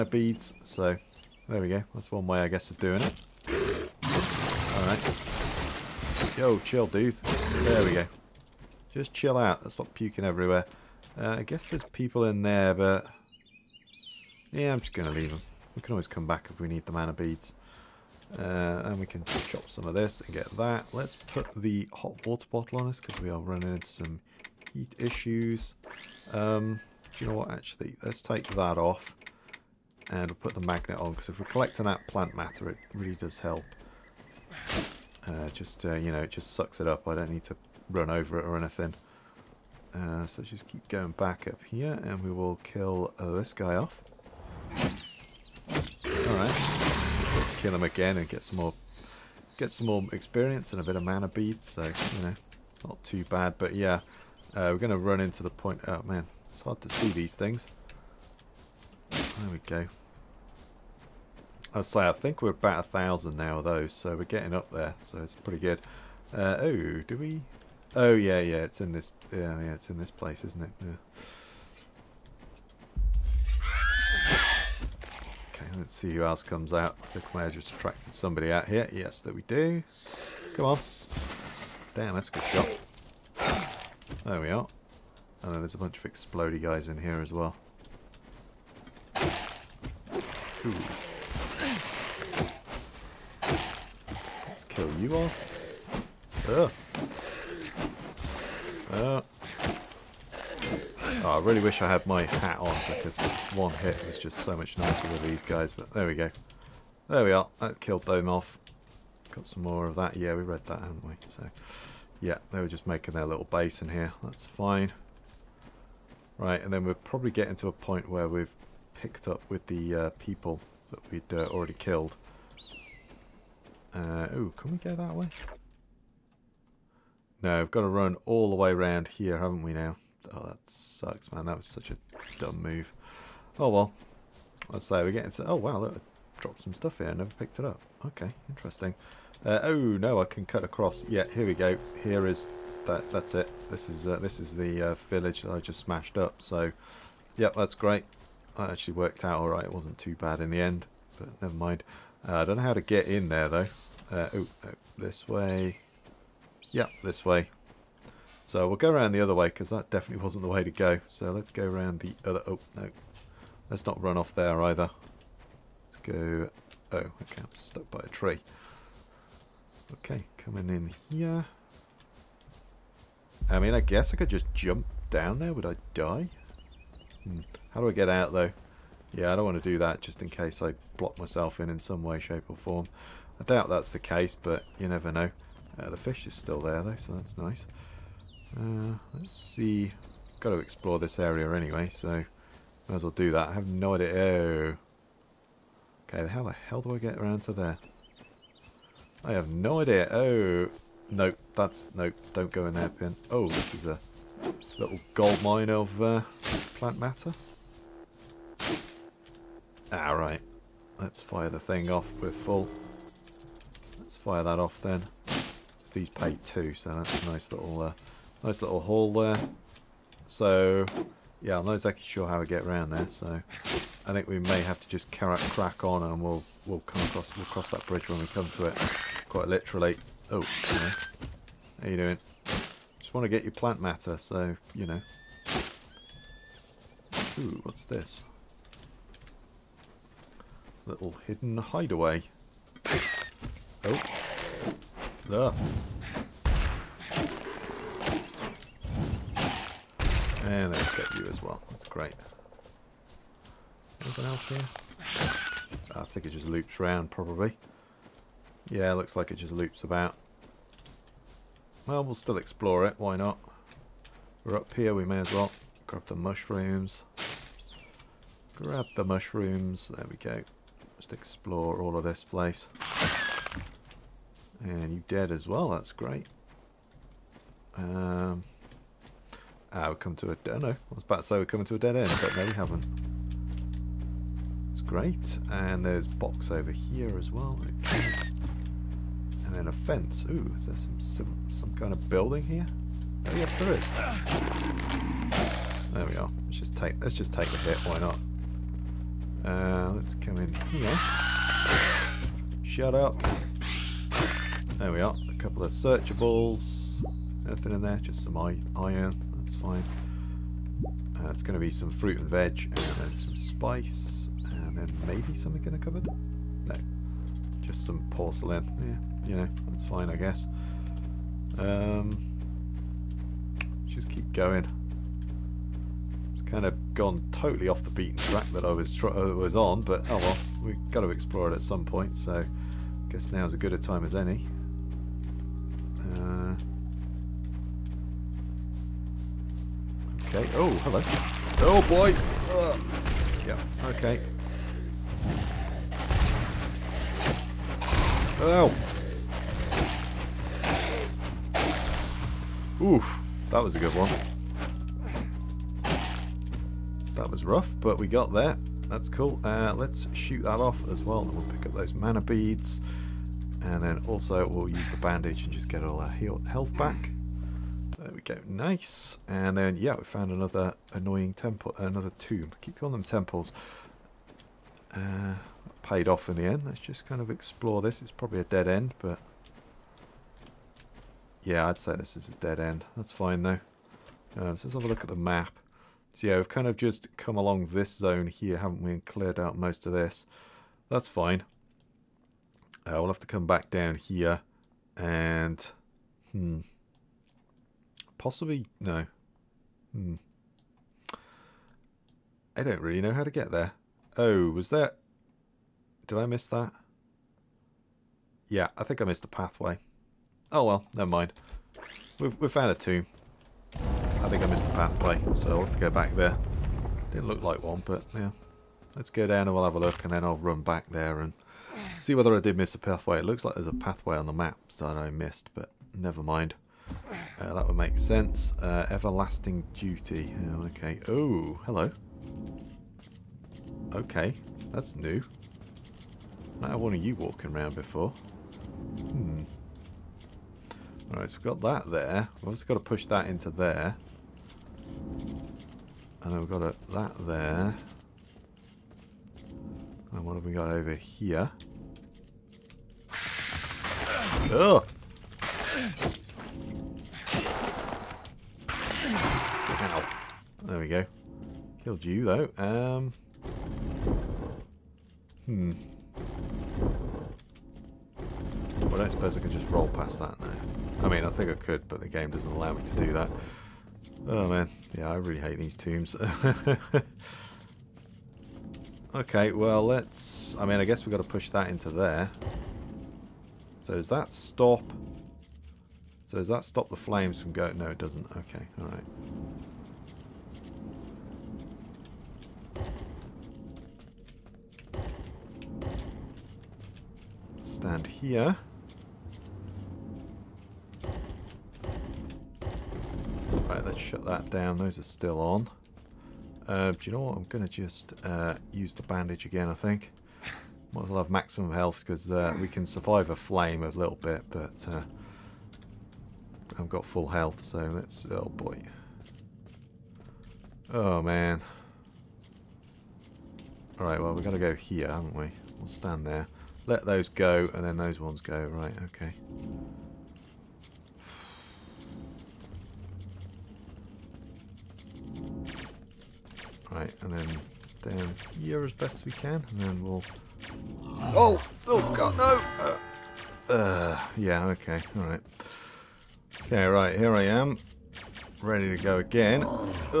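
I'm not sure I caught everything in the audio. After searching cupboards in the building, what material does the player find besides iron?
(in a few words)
porcelain.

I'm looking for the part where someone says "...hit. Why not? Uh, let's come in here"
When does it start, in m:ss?
4:57.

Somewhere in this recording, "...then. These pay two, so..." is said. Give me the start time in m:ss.
3:34.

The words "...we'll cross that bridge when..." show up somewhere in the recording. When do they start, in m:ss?
3:47.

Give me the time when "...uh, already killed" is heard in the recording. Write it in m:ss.
2:01.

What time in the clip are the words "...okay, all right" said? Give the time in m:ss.
9:04.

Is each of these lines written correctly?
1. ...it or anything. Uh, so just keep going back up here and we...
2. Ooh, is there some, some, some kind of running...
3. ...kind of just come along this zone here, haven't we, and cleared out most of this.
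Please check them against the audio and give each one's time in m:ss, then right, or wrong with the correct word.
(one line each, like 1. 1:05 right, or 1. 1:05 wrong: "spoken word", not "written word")
1. 0:38 right
2. 4:50 wrong: "building", not "running"
3. 6:26 right.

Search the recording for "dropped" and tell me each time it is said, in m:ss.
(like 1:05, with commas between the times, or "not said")
2:16.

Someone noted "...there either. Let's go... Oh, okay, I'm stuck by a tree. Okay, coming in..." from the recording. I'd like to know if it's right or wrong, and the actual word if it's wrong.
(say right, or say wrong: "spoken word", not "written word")
right.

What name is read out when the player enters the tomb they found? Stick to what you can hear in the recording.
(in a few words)
Everlasting Duty.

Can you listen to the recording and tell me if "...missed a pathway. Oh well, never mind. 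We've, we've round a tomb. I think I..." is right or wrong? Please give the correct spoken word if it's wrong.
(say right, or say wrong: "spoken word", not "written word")
wrong: "found", not "round".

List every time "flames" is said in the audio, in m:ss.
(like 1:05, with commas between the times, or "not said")
8:06, 8:33.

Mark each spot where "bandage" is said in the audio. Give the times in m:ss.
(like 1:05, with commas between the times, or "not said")
6:04, 8:29.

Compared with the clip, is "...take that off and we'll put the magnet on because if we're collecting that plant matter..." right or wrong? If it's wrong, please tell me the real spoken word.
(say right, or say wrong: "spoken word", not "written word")
right.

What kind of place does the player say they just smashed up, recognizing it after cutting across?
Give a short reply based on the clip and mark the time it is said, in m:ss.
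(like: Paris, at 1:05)
village, at 2:25.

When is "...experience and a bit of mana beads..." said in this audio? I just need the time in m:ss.
0:50.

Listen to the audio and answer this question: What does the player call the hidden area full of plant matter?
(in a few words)
gold mine.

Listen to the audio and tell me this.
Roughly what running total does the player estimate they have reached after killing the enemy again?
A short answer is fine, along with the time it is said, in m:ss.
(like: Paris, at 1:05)
1000, at 1:02.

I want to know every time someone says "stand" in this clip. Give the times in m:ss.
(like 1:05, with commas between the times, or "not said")
8:17, 8:45.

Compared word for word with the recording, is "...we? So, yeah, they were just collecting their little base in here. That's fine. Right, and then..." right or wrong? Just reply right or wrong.
wrong.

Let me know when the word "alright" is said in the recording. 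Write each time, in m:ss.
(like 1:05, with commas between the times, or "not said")
0:04, 0:44, 3:29, 7:21, 8:08, 8:44.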